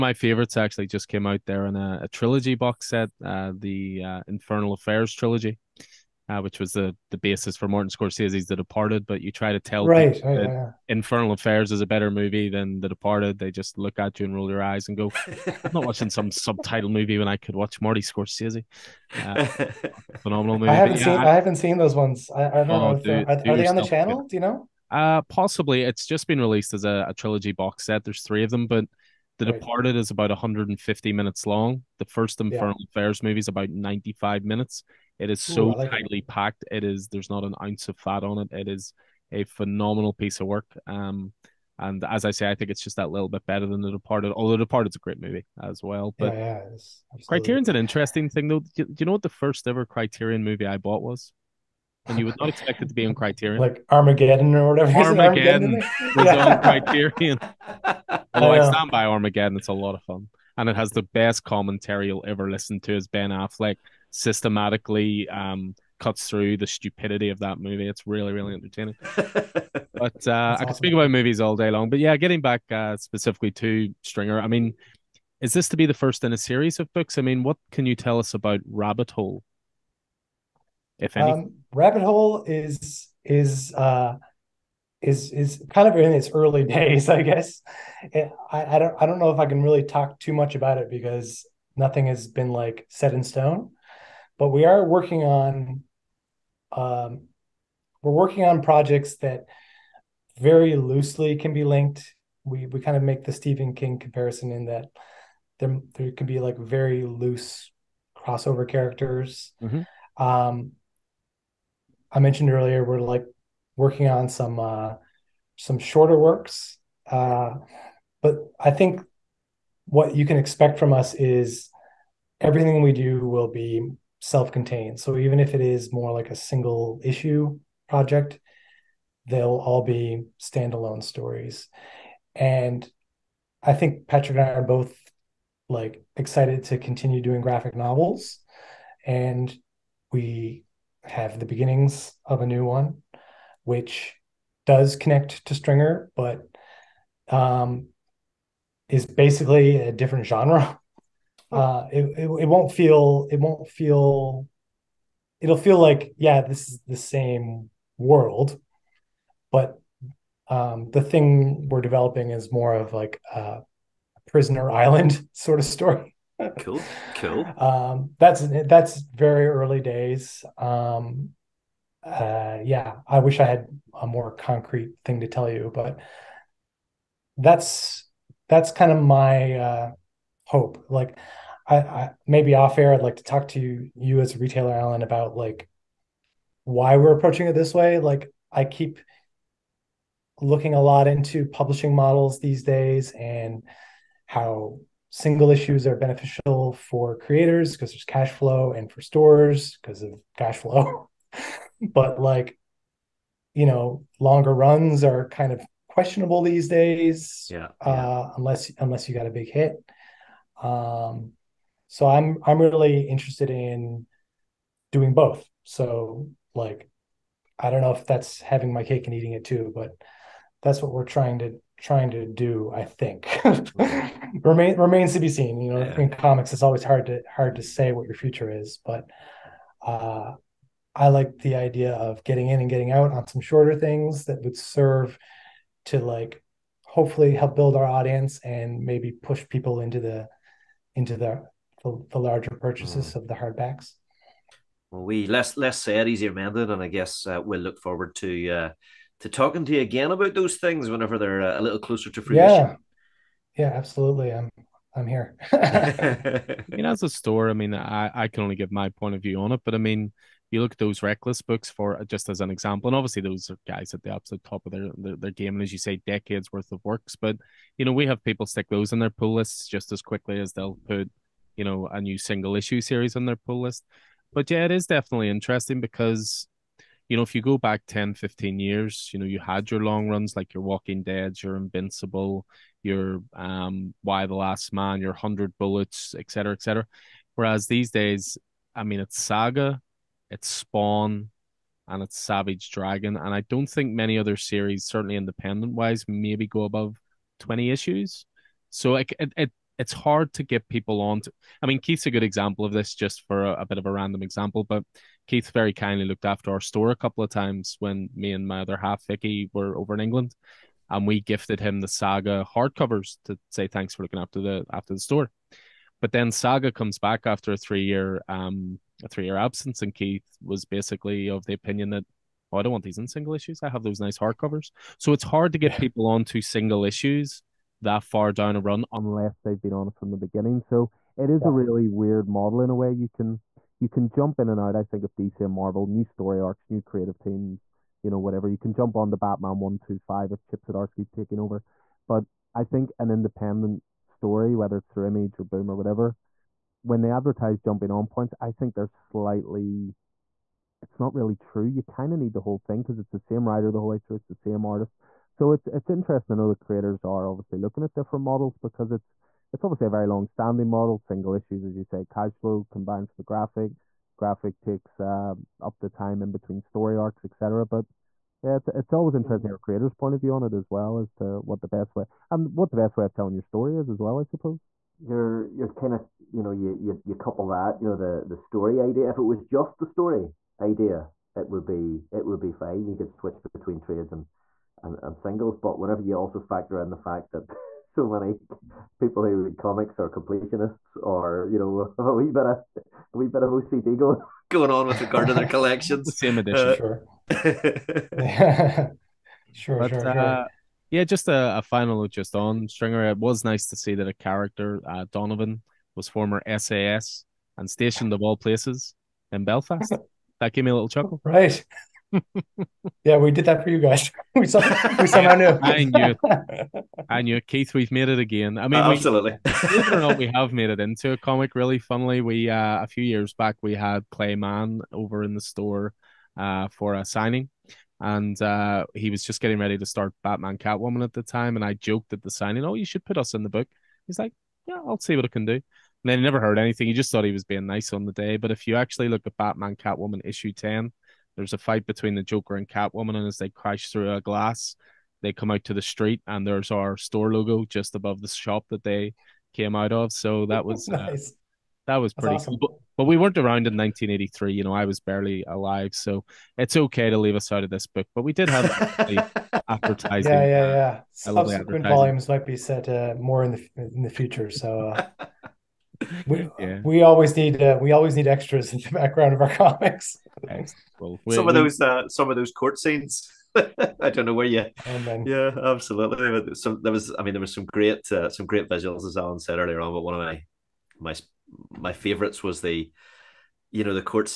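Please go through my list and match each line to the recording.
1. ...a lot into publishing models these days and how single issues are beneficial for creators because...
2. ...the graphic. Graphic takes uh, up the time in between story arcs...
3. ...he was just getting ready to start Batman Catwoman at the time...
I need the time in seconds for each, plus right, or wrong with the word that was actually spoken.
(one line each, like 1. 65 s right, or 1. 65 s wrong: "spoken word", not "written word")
1. 190 s right
2. 363 s right
3. 428 s right.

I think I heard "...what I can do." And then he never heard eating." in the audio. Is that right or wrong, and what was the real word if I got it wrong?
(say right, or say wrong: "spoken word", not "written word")
wrong: "anything", not "eating".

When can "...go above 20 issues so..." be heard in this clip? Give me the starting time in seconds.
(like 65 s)
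296 s.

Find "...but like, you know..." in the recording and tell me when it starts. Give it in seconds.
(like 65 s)
201 s.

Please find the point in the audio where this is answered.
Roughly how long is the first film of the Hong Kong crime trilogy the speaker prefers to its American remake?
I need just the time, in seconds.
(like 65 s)
33 s.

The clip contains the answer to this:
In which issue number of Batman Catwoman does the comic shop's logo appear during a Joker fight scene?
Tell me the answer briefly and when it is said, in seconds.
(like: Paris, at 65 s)
10, at 440 s.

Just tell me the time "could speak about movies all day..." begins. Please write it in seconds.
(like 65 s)
70 s.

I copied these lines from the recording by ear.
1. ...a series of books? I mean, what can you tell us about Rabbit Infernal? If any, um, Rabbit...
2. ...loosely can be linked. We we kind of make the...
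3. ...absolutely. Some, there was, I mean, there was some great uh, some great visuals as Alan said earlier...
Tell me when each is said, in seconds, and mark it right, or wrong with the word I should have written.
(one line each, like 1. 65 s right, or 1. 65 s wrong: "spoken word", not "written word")
1. 76 s wrong: "Hole", not "Infernal"
2. 100 s right
3. 475 s right.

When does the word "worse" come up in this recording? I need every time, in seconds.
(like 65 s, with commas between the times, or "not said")
not said.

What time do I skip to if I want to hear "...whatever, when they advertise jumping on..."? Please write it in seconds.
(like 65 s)
345 s.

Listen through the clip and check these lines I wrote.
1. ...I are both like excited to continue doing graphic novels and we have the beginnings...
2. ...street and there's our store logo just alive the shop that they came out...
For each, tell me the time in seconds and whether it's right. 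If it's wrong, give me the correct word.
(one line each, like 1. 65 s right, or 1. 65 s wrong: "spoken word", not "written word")
1. 134 s right
2. 445 s wrong: "above", not "alive".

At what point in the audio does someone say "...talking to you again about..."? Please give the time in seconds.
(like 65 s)
249 s.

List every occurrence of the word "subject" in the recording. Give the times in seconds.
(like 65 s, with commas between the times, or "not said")
not said.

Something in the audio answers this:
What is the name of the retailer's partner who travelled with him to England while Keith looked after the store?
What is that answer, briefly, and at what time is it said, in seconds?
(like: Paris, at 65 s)
Vicky, at 309 s.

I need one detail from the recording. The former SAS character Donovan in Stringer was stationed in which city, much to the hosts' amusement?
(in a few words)
Belfast.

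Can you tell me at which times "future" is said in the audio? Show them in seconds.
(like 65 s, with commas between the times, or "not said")
228 s, 464 s.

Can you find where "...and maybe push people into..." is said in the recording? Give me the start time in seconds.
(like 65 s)
238 s.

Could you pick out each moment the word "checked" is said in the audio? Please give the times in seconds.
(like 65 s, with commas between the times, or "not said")
not said.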